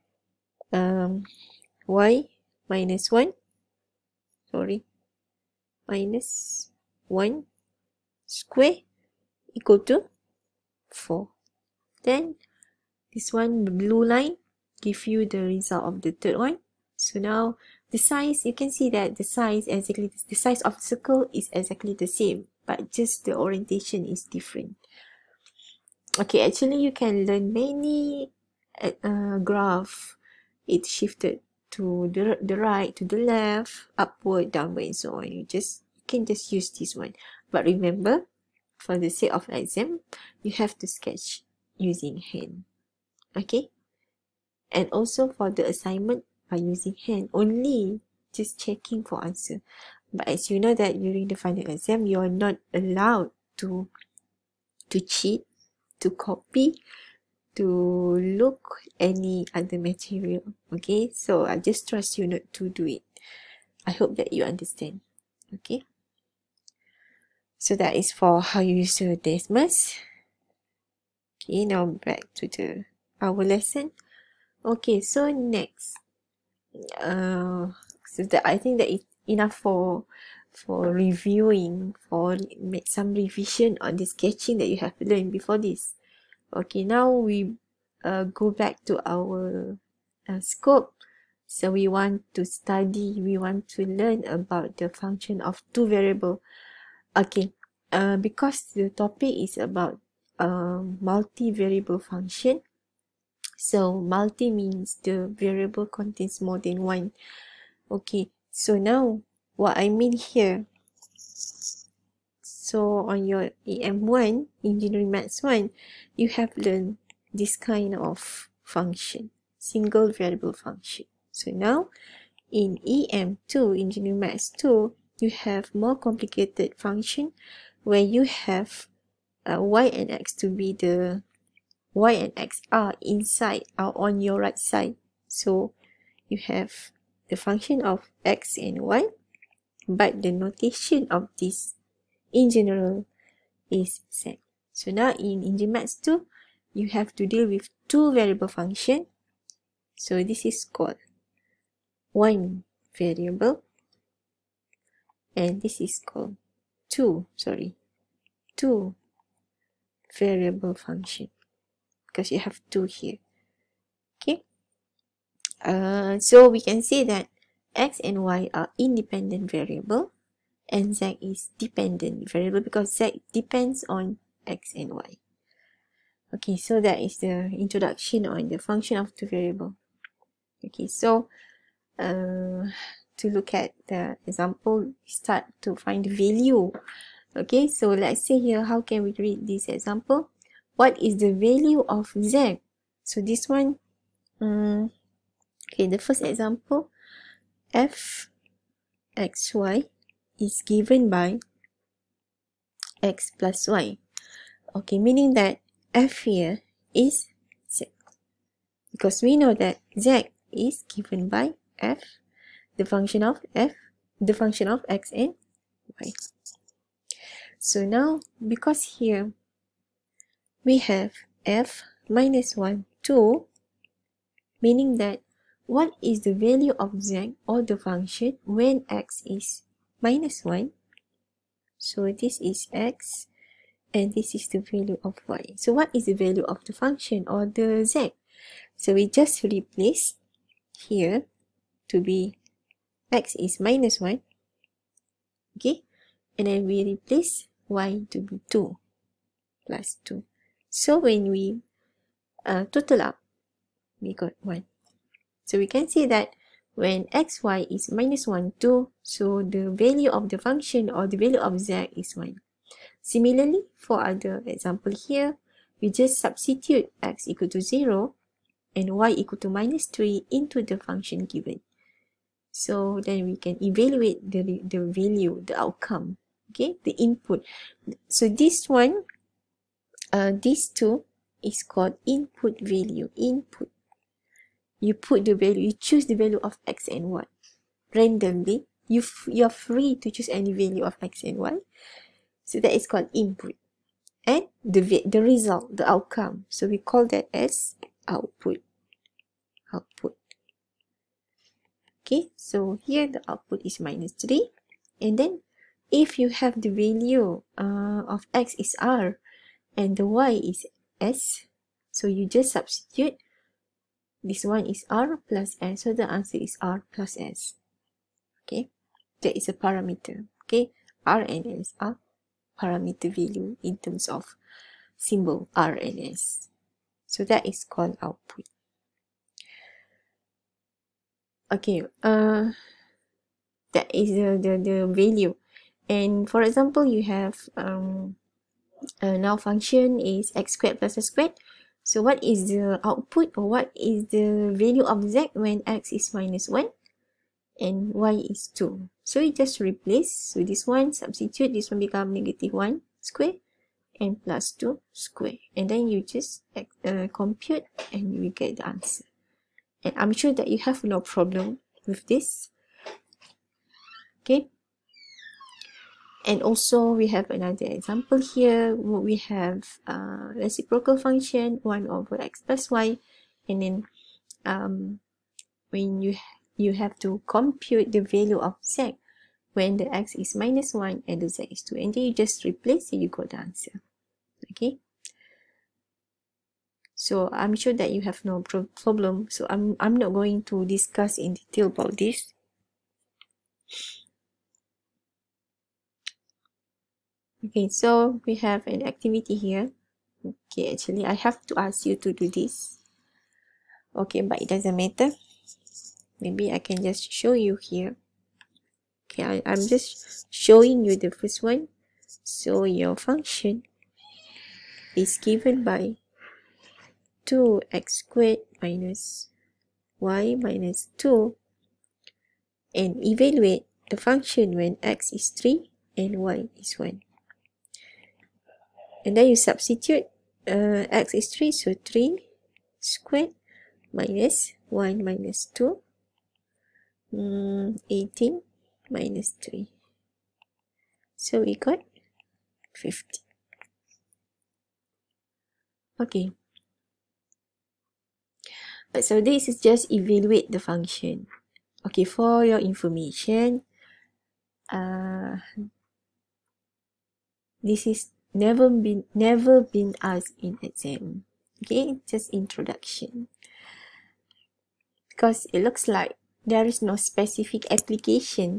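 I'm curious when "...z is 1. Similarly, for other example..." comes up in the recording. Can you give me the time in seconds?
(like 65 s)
261 s.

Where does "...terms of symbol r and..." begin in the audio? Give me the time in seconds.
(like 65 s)
323 s.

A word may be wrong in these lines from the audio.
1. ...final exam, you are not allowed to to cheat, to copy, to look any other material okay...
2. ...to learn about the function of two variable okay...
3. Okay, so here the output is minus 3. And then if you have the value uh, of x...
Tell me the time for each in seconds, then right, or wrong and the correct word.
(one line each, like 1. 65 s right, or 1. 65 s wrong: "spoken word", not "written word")
1. 51 s right
2. 93 s right
3. 302 s right.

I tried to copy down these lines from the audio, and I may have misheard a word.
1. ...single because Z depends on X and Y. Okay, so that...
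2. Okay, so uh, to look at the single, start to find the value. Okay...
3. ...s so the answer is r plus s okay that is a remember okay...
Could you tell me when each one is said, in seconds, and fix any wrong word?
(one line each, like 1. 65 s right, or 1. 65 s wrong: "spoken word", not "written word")
1. 172 s wrong: "variable", not "single"
2. 180 s wrong: "example", not "single"
3. 315 s wrong: "parameter", not "remember".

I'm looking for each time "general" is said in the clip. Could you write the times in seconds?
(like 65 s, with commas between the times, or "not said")
142 s.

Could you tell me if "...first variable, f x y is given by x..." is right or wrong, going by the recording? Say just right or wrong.
wrong.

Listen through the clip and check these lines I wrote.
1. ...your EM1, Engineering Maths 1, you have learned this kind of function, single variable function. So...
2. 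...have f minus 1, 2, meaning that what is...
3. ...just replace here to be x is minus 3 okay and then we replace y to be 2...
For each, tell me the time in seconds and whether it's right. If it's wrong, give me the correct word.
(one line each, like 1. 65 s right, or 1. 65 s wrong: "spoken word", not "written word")
1. 113 s right
2. 220 s right
3. 239 s wrong: "1", not "3".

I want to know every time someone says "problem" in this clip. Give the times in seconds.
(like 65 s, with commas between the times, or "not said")
361 s, 388 s.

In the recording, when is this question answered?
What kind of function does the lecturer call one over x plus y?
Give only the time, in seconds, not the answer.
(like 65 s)
370 s.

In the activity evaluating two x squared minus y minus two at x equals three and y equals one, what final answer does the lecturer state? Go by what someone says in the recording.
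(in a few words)
50.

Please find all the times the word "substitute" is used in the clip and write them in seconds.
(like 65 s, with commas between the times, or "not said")
266 s, 312 s, 350 s, 429 s.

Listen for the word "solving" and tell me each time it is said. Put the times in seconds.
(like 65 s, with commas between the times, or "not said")
not said.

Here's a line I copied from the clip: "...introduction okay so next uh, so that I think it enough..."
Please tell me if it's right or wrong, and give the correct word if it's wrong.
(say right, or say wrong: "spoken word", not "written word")
wrong: "lesson", not "introduction".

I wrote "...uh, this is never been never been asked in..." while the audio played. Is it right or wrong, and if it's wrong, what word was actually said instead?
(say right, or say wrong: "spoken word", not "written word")
right.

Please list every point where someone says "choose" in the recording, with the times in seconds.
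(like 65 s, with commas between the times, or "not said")
285 s, 290 s.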